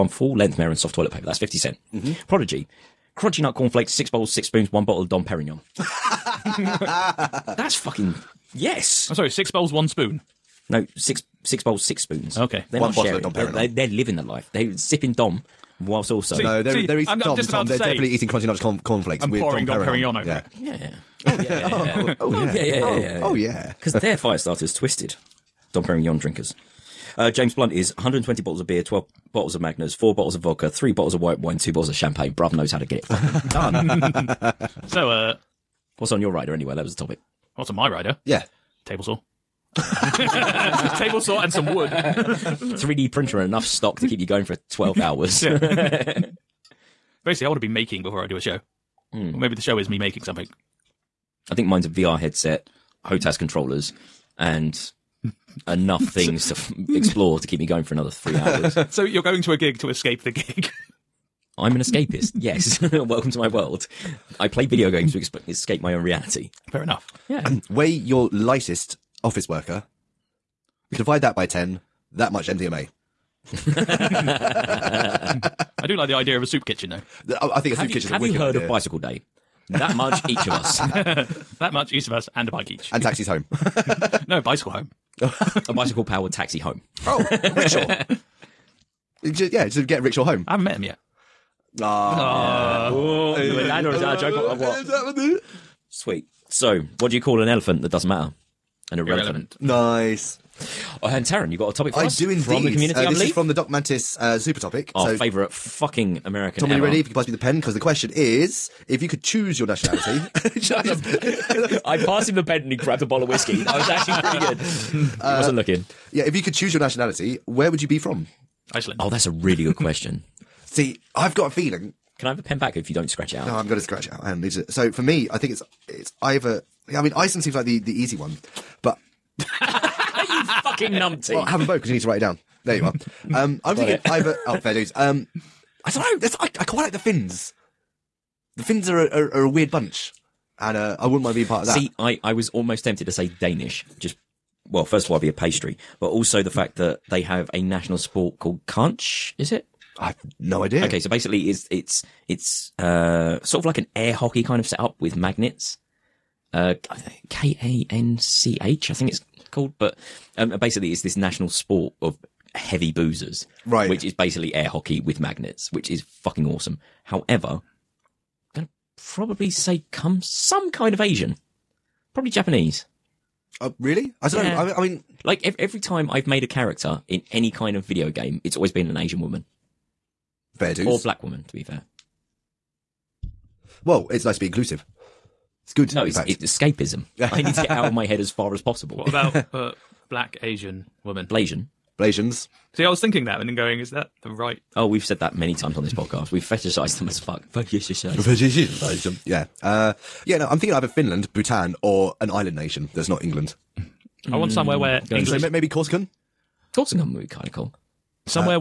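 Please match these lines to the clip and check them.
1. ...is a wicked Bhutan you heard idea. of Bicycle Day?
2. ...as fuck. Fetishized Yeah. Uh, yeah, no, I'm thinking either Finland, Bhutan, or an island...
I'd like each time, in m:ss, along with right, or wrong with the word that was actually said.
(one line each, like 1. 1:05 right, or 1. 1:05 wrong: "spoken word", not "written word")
1. 1:18 wrong: "Have", not "Bhutan"
2. 3:17 right.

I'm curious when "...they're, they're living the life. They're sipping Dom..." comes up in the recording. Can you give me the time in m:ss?
0:13.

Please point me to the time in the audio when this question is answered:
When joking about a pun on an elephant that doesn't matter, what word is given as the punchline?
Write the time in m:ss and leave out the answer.
1:38.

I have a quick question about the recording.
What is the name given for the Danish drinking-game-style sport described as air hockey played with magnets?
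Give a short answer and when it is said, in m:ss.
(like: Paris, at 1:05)
Kanch, at 2:28.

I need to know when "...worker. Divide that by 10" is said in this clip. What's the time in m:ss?
1:09.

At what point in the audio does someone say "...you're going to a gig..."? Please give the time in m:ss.
0:59.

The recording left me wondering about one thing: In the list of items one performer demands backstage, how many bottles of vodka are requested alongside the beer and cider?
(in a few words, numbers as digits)
4.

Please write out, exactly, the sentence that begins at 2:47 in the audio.
However, I'm gonna probably say come some kind of Asian.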